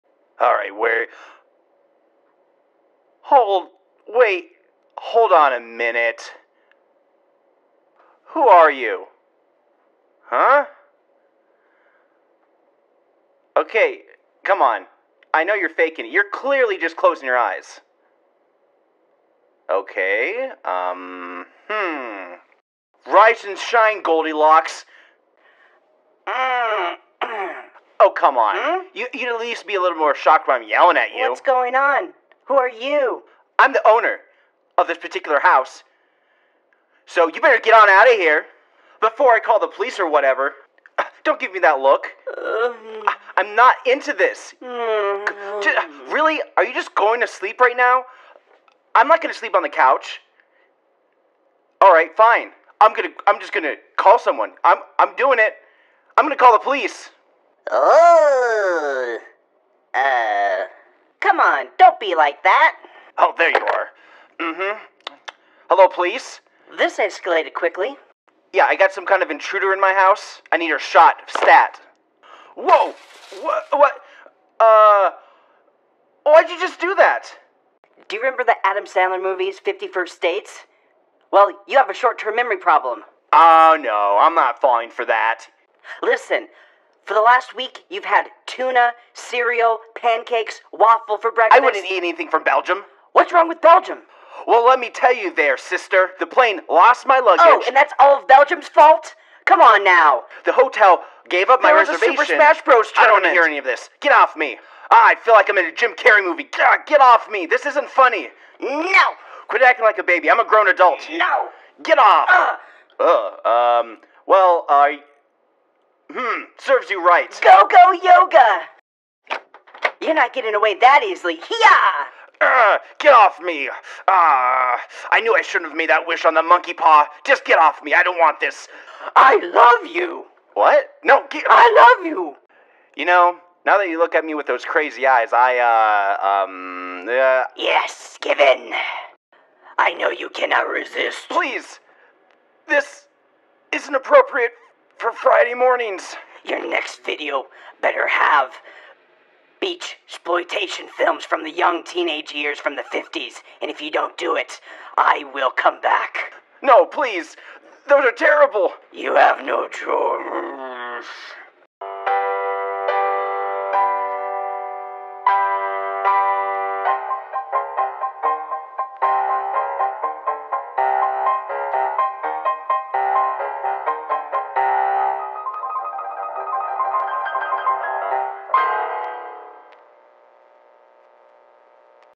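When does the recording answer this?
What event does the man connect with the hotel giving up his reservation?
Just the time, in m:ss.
1:42.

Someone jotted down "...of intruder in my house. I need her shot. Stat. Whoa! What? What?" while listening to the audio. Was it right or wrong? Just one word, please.
right.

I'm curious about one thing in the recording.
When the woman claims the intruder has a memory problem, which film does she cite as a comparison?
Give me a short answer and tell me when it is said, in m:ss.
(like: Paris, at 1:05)
50 First Dates, at 1:19.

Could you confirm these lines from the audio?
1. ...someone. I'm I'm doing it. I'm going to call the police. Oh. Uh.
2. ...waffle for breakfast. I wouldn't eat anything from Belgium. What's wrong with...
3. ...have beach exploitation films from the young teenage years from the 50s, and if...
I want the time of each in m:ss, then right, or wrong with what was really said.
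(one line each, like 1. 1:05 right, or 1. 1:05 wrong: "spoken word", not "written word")
1. 0:54 right
2. 1:30 right
3. 2:28 right.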